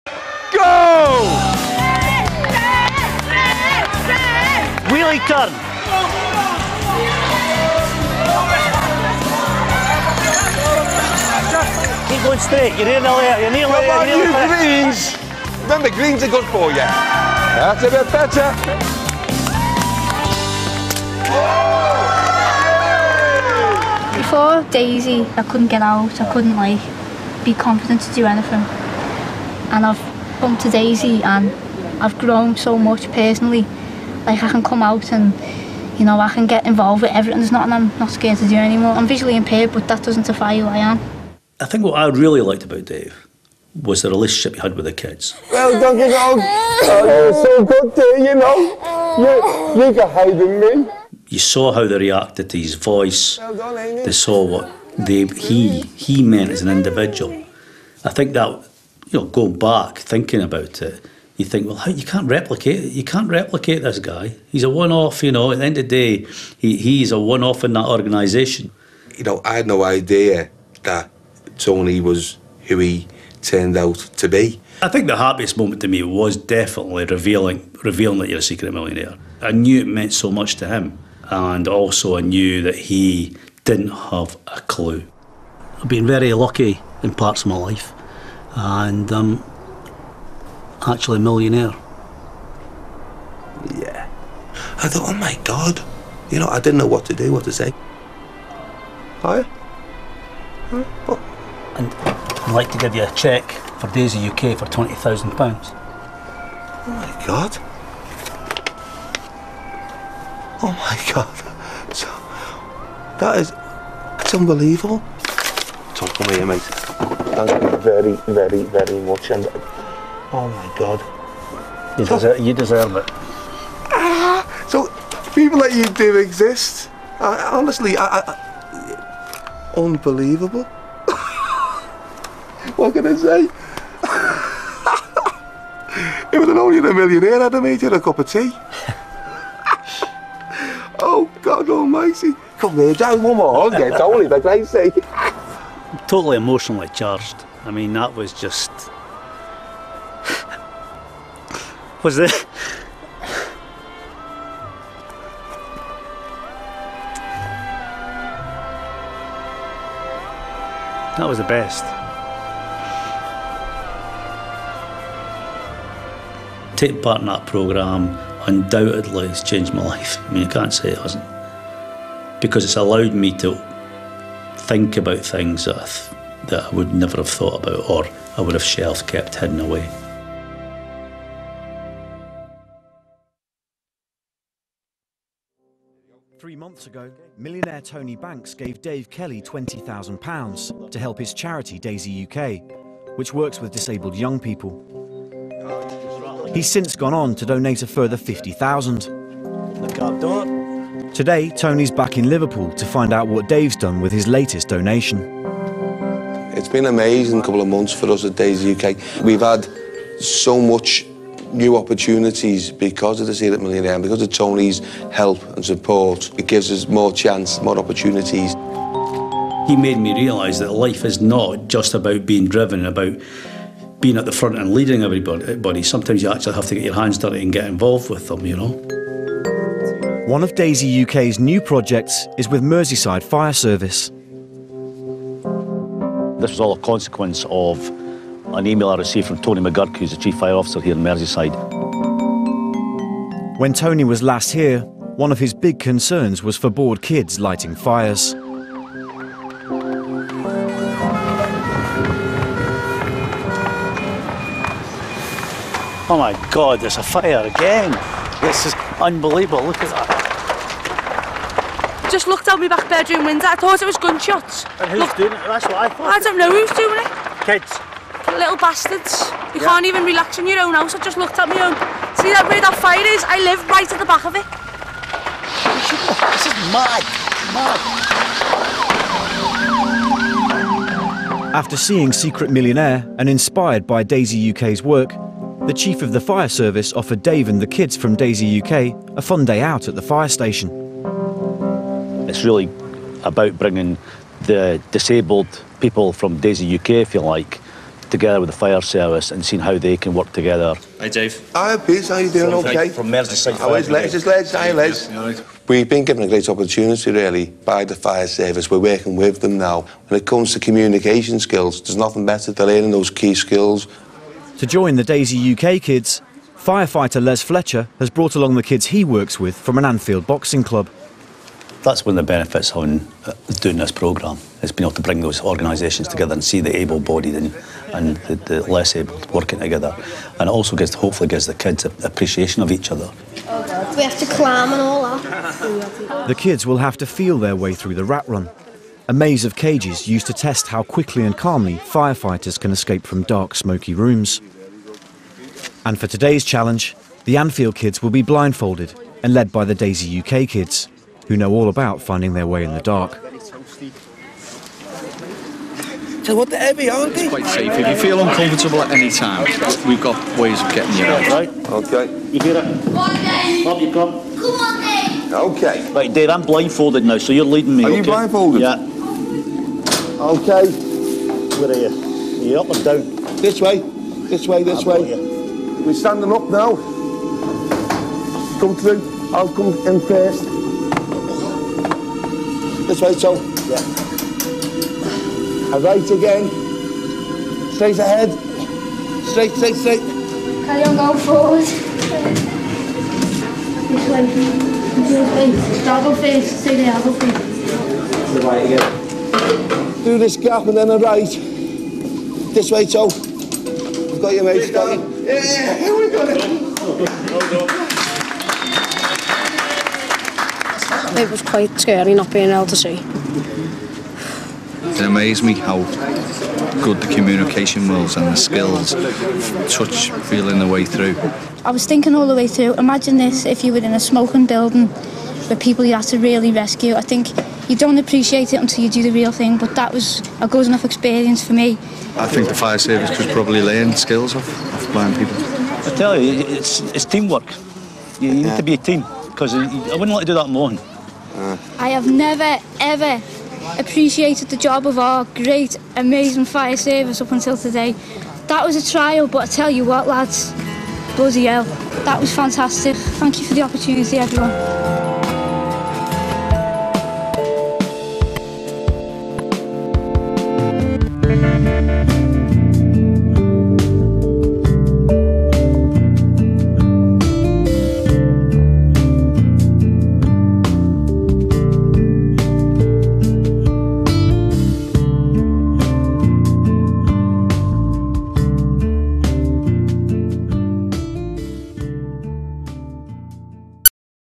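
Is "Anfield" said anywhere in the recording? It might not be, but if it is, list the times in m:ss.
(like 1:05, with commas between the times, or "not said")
5:19, 5:47.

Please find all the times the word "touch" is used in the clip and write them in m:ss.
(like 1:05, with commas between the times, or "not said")
6:59.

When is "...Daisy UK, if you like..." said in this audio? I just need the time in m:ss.
4:56.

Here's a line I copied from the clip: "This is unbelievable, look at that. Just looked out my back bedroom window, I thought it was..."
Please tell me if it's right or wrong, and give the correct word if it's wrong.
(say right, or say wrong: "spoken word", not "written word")
right.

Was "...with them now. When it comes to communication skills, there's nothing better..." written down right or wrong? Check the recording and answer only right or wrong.
right.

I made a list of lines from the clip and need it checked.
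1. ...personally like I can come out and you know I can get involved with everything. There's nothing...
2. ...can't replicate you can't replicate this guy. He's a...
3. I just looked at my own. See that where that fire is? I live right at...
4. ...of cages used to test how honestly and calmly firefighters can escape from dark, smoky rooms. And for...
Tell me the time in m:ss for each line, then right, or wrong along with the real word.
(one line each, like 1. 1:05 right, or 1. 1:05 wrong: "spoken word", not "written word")
1. 0:33 right
2. 1:02 right
3. 4:30 right
4. 5:39 wrong: "quickly", not "honestly".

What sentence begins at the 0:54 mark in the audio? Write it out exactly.
They saw what they, he he meant as an individual.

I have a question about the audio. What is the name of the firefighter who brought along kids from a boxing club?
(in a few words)
Les Fletcher.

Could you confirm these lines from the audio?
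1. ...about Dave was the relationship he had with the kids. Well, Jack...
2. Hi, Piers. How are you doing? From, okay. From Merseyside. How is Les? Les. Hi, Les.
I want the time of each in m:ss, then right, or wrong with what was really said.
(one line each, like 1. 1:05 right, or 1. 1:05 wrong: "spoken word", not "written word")
1. 0:42 wrong: "Doggy", not "Jack"
2. 5:01 right.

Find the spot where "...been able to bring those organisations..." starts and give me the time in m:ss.
5:24.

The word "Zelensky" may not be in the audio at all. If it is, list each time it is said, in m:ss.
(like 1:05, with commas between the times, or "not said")
not said.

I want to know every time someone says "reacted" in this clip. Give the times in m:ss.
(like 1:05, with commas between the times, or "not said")
0:51.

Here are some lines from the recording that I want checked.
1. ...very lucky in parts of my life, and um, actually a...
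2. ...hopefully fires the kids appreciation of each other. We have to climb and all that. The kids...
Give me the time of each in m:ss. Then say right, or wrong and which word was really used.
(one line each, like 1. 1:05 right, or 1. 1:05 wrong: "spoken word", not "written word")
1. 1:26 right
2. 5:30 wrong: "gives", not "fires".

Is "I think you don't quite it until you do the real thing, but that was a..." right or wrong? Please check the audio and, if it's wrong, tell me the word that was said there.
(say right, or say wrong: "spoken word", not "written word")
wrong: "appreciate", not "quite".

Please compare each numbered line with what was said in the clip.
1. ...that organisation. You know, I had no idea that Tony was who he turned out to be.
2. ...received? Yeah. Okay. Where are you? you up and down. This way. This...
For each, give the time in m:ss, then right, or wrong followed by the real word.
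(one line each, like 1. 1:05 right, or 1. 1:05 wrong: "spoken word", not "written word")
1. 1:07 right
2. 6:08 wrong: "blindfolded", not "received".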